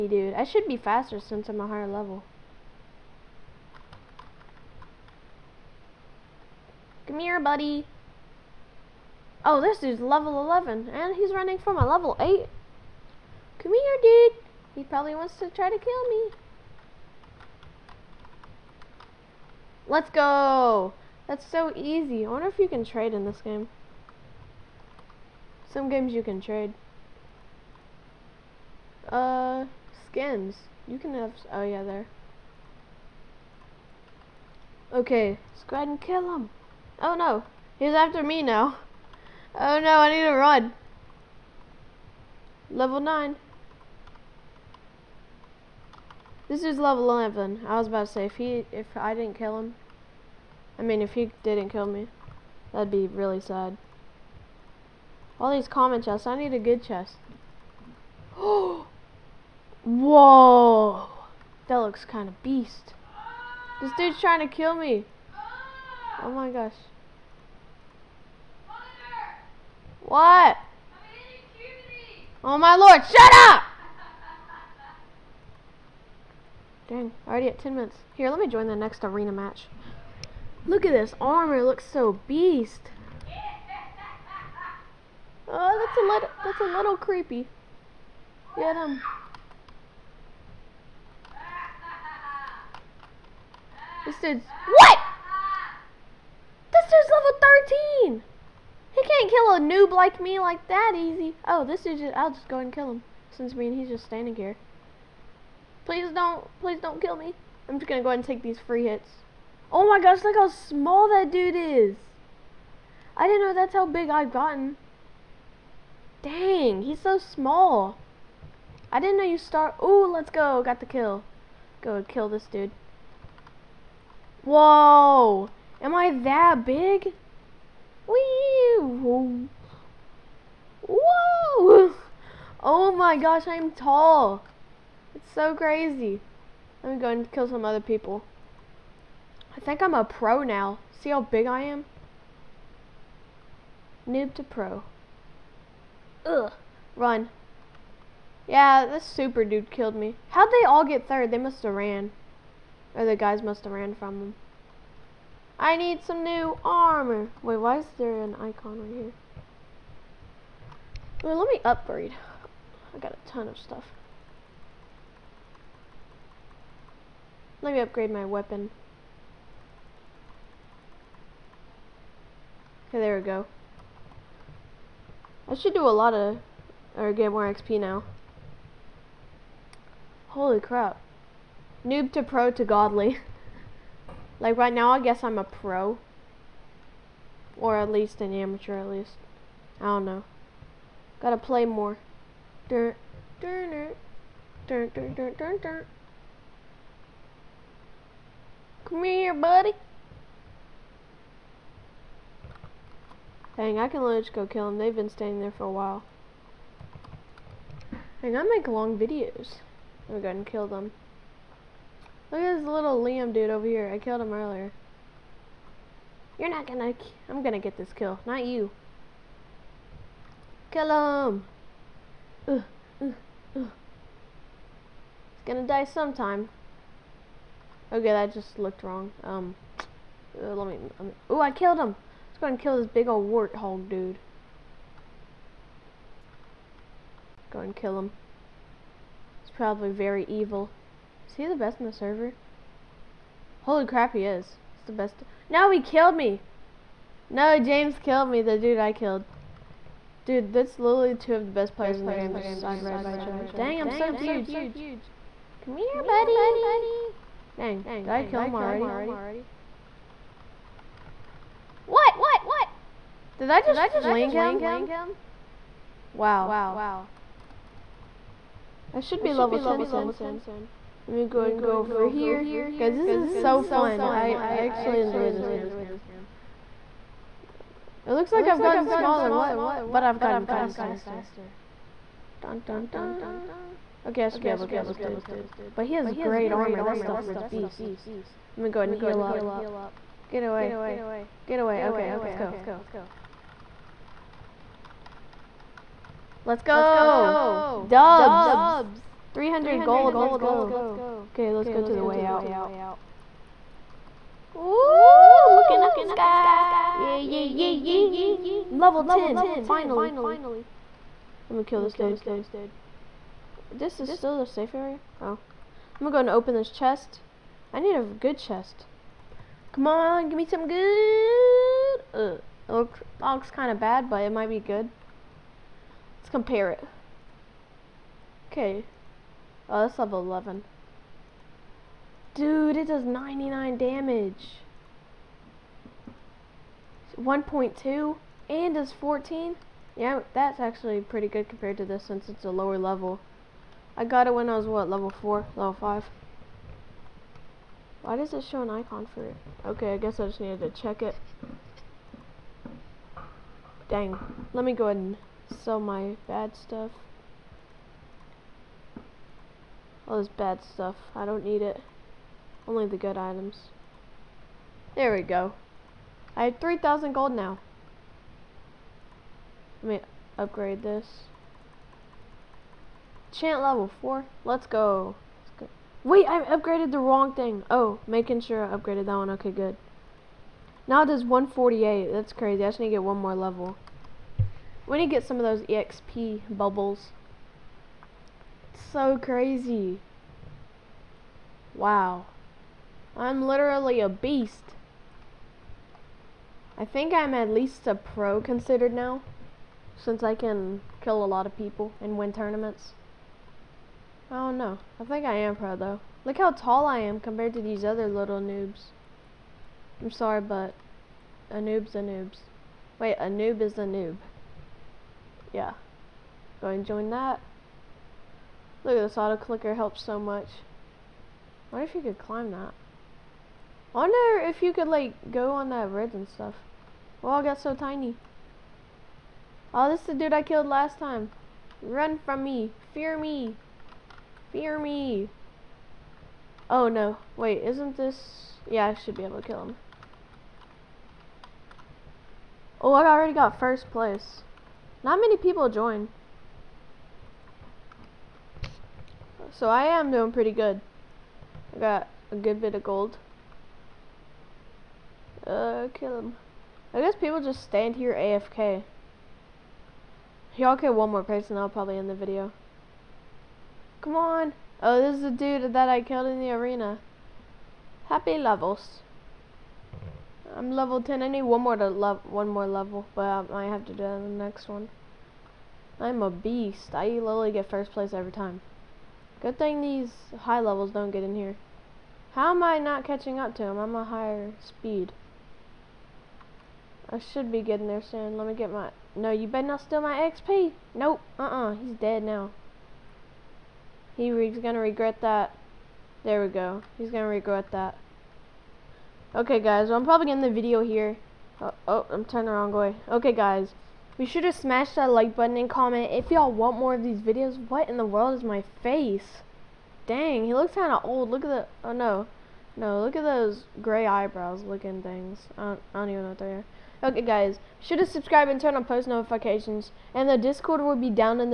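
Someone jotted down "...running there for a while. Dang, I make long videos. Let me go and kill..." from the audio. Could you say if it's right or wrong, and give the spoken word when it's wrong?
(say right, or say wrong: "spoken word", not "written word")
wrong: "standing", not "running".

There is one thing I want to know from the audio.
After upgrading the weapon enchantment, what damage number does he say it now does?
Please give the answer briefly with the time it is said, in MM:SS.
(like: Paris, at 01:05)
148, at 06:21.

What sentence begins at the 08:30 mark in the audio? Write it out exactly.
Dang, he looks kind of old.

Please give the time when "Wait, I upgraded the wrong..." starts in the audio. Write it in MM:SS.
06:16.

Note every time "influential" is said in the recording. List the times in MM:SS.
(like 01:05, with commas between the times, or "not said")
not said.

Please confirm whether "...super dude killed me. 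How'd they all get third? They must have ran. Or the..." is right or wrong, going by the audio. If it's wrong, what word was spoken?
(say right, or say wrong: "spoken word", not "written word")
right.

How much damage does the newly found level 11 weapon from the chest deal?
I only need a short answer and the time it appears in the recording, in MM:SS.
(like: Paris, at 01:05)
99, at 05:33.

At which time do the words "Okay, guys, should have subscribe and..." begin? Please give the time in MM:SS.
08:37.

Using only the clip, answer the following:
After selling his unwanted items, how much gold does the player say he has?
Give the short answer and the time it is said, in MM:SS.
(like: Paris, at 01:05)
3,000, at 06:06.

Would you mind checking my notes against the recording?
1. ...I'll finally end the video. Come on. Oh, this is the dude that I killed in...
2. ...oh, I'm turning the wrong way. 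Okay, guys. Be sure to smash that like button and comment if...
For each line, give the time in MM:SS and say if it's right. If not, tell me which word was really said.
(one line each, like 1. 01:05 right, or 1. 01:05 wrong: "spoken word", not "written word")
1. 07:41 wrong: "probably", not "finally"
2. 08:21 right.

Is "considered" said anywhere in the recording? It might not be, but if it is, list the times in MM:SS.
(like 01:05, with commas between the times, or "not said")
06:38.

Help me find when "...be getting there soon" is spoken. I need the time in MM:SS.
08:07.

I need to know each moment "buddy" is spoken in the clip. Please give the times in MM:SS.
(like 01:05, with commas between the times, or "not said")
00:07, 03:19, 04:16.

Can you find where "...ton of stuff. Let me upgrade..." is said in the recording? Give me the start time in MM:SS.
02:43.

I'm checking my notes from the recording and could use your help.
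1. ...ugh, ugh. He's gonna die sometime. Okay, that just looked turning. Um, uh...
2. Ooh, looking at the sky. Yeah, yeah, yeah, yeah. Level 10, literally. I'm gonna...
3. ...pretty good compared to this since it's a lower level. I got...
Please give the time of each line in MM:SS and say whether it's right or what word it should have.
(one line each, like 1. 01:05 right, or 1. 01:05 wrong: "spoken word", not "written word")
1. 03:43 wrong: "wrong", not "turning"
2. 05:04 wrong: "finally", not "literally"
3. 05:41 right.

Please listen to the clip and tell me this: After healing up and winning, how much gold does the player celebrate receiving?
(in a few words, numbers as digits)
300.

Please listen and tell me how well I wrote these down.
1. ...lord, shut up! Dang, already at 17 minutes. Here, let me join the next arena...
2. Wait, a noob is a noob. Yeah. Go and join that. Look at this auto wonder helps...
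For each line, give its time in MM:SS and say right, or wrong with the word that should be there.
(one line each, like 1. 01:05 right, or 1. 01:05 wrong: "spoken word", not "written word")
1. 01:12 wrong: "10", not "17"
2. 06:52 wrong: "clicker", not "wonder".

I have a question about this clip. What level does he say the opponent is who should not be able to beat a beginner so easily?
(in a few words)
13.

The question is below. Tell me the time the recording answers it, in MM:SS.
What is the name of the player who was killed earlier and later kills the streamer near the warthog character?
04:07.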